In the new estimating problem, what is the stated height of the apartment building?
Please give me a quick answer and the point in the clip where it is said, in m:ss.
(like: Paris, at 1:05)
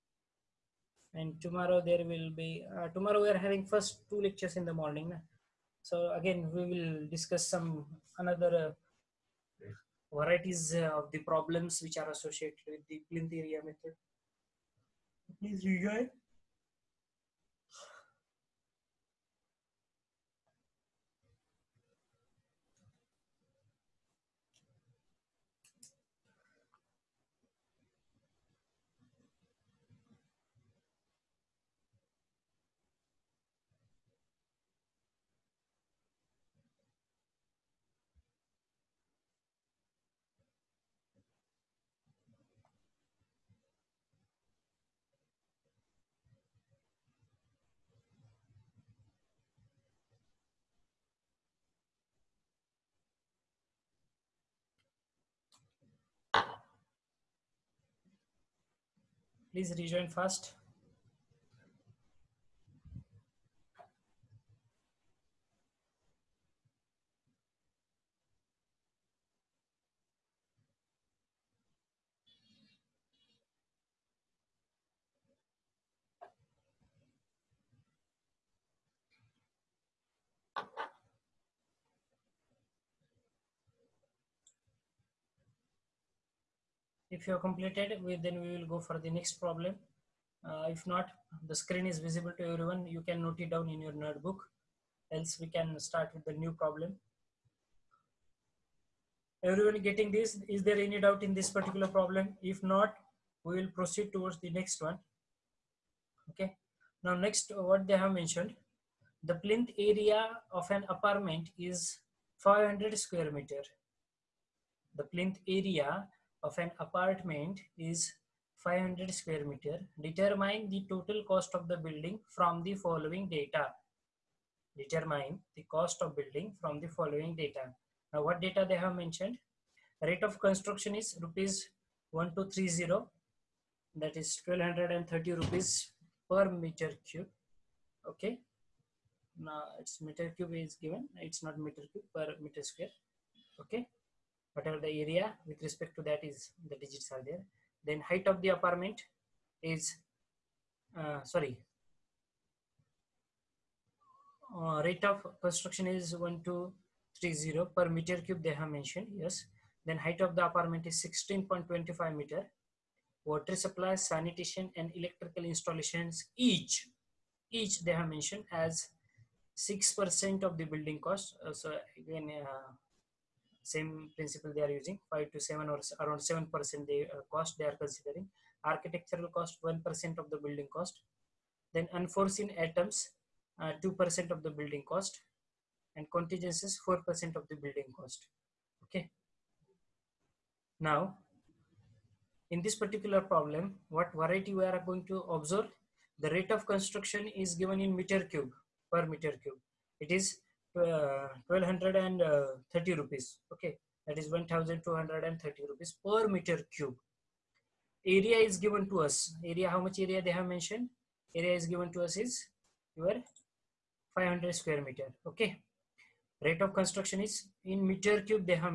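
16.25 meters, at 2:41.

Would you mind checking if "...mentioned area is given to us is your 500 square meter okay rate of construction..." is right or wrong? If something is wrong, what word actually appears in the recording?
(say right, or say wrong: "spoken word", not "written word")
right.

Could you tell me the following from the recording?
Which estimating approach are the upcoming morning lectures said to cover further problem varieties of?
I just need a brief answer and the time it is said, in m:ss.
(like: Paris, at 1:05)
Plinth area method, at 0:13.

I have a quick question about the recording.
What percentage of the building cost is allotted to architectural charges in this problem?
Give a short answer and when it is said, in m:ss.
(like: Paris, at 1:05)
1%, at 2:59.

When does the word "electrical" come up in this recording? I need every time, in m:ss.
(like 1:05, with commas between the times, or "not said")
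2:44.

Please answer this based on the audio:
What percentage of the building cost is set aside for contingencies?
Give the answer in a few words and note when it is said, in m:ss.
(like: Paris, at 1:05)
4%, at 3:06.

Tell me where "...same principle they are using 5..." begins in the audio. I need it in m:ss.
2:53.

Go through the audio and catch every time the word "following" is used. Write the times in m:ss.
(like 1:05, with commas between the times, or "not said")
2:02, 2:06.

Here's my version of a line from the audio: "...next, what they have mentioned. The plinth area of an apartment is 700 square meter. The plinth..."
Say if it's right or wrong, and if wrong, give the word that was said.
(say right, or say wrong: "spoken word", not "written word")
wrong: "500", not "700".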